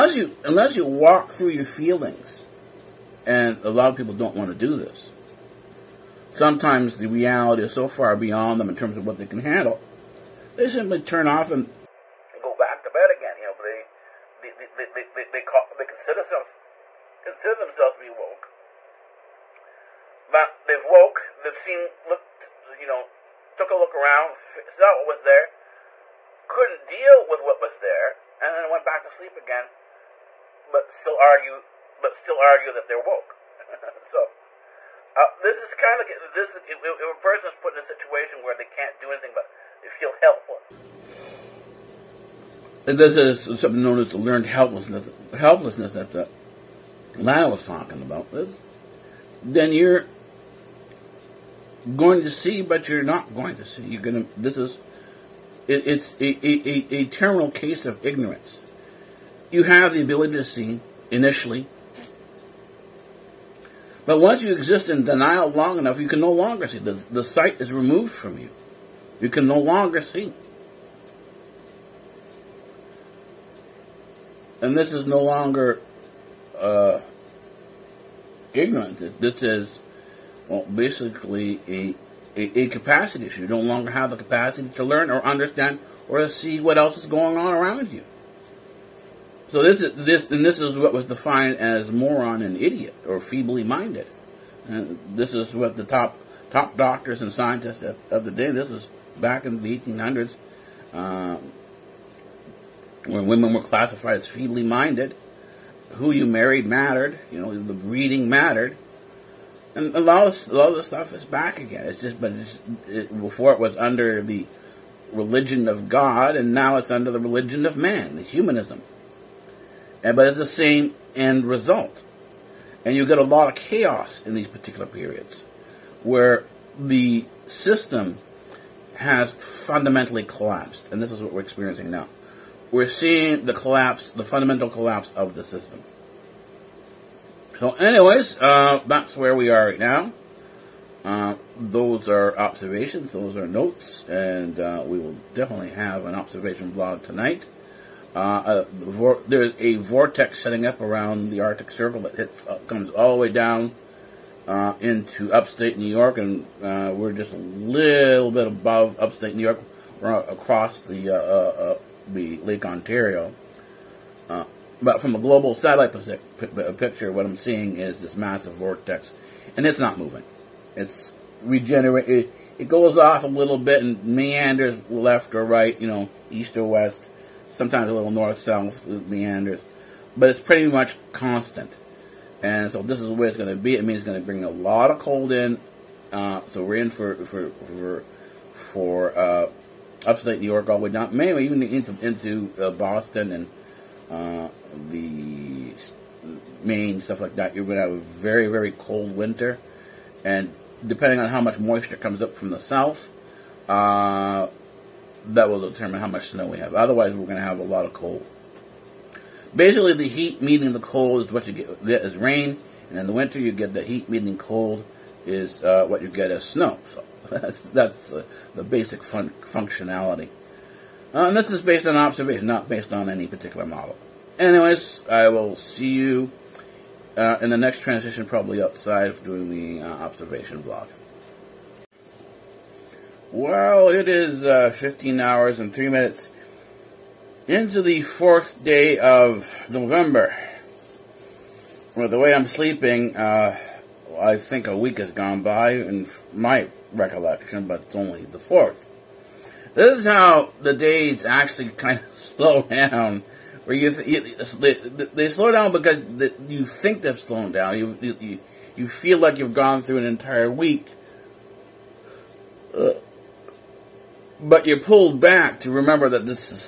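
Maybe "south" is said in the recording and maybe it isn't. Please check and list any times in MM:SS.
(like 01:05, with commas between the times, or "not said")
02:58, 03:22.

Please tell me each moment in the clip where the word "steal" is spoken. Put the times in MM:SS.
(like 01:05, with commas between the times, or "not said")
not said.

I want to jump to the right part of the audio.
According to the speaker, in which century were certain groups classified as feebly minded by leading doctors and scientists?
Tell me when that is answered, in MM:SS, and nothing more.
01:39.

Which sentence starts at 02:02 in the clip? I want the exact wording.
And you get a lot of chaos in these particular periods where the system has fundamentally collapsed.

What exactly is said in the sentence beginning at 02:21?
Uh, those are observations, those are notes, and uh, we will definitely have an observation vlog tonight.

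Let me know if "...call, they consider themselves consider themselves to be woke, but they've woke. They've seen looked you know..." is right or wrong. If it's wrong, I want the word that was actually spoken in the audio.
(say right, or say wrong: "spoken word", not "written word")
right.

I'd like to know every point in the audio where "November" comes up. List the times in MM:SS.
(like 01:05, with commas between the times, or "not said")
03:59.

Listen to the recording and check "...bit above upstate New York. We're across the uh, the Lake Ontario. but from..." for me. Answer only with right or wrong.
right.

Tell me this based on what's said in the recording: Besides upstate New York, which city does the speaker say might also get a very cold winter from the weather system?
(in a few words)
Boston.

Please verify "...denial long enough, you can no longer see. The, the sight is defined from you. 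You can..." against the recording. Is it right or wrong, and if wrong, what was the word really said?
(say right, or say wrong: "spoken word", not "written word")
wrong: "removed", not "defined".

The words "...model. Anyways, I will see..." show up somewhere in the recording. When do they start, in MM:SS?
03:43.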